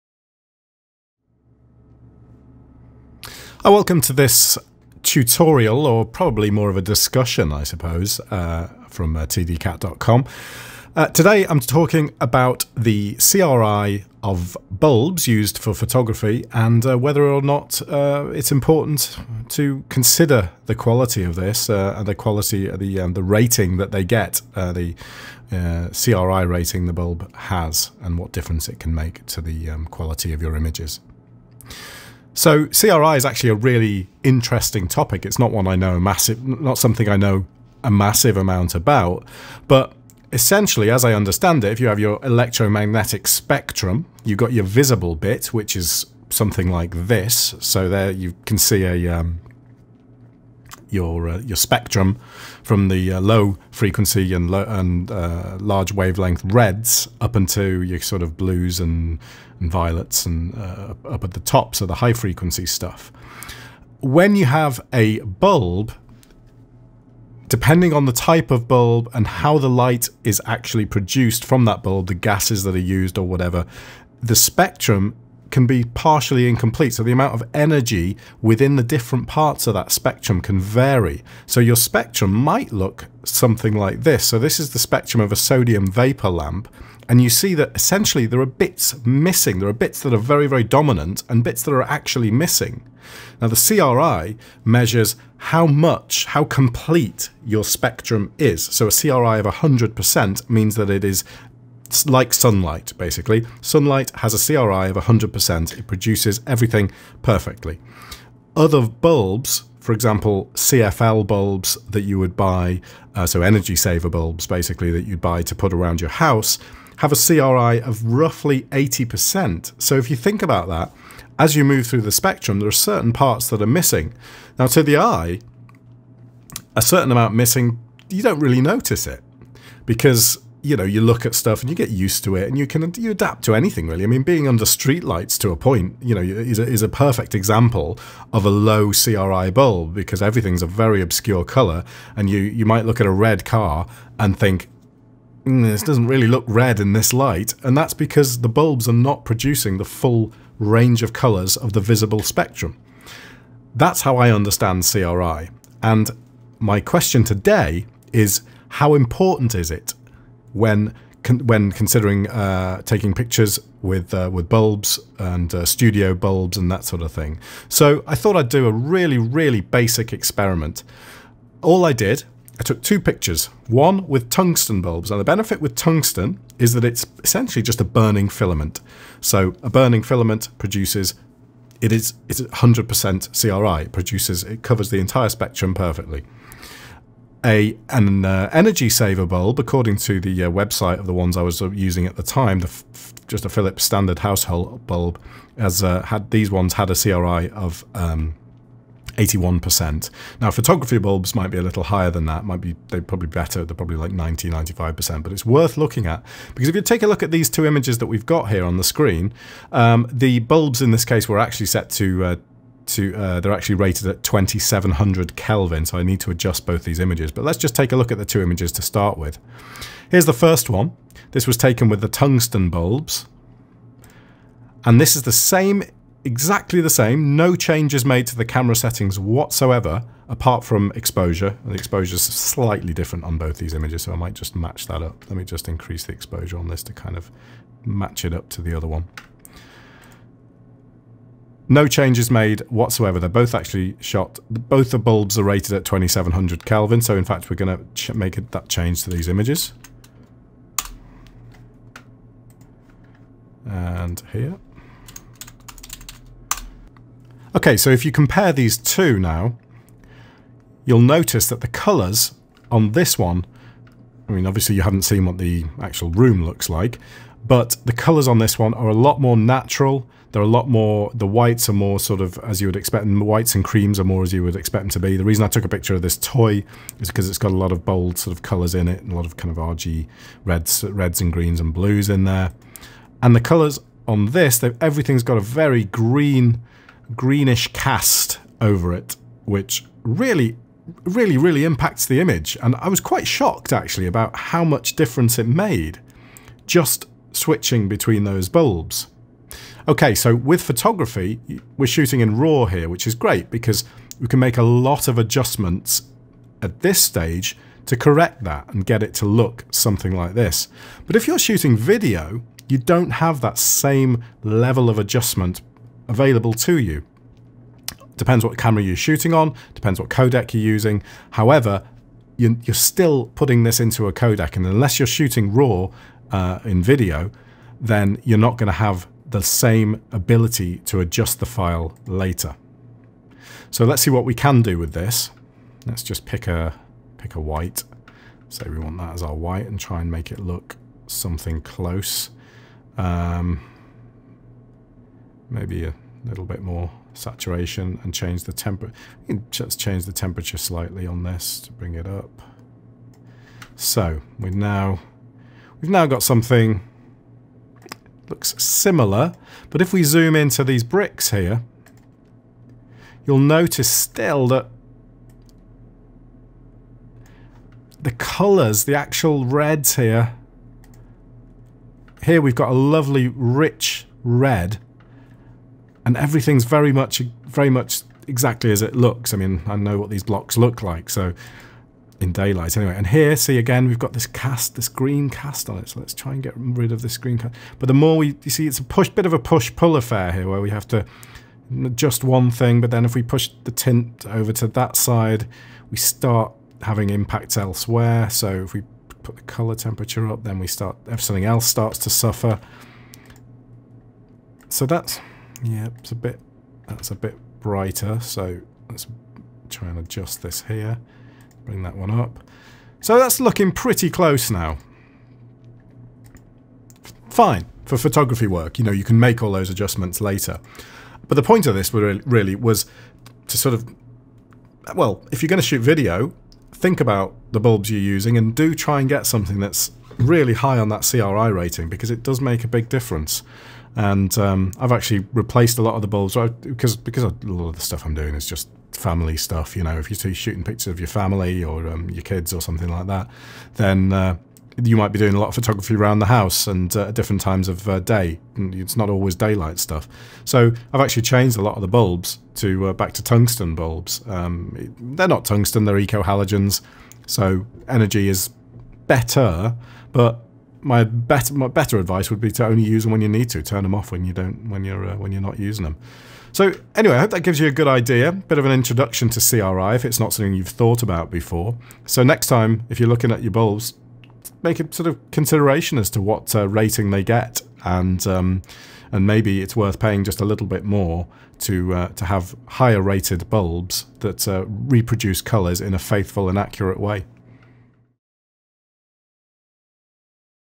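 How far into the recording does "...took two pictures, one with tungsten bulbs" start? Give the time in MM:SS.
02:52.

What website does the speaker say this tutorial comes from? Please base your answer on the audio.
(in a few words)
tdcat.com.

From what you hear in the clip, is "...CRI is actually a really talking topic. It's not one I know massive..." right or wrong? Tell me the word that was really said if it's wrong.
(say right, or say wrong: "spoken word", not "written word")
wrong: "interesting", not "talking".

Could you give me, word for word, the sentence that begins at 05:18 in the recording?
Depends what camera you're shooting on, depends what codec you're using.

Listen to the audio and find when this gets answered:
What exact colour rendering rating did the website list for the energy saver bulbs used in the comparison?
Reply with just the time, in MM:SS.
03:19.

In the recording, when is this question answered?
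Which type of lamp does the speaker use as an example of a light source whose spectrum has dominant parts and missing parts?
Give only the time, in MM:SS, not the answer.
01:25.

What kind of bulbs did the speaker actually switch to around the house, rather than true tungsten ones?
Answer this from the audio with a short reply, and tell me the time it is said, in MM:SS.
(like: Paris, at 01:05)
eco halogens, at 07:35.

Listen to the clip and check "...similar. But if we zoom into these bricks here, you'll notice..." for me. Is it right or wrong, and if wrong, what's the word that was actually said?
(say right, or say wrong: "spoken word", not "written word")
right.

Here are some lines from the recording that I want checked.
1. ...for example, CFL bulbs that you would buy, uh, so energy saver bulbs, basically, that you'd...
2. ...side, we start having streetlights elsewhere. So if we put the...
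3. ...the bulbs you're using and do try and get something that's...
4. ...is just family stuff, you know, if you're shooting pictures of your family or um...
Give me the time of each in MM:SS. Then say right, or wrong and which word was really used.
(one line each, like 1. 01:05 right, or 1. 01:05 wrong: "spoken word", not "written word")
1. 01:49 right
2. 06:34 wrong: "impacts", not "streetlights"
3. 07:07 right
4. 07:18 right.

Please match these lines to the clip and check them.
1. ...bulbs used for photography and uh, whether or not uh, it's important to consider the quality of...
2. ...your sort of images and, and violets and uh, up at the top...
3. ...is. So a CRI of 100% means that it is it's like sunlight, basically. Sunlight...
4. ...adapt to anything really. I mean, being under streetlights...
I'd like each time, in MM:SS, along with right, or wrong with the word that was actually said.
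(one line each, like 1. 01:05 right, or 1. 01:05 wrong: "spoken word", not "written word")
1. 00:14 right
2. 00:57 wrong: "blues", not "images"
3. 01:38 right
4. 02:13 right.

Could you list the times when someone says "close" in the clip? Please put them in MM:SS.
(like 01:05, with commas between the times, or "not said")
05:41, 06:54.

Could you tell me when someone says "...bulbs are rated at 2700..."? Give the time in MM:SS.
04:04.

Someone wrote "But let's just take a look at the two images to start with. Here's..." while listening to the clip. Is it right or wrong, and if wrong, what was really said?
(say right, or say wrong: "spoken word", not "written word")
right.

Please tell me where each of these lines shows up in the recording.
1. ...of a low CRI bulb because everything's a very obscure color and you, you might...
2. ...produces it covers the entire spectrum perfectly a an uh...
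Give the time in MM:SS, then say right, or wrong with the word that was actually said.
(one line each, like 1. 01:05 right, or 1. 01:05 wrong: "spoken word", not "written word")
1. 02:18 right
2. 03:03 right.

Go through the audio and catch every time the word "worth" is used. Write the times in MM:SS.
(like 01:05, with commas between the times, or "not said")
03:25, 07:59.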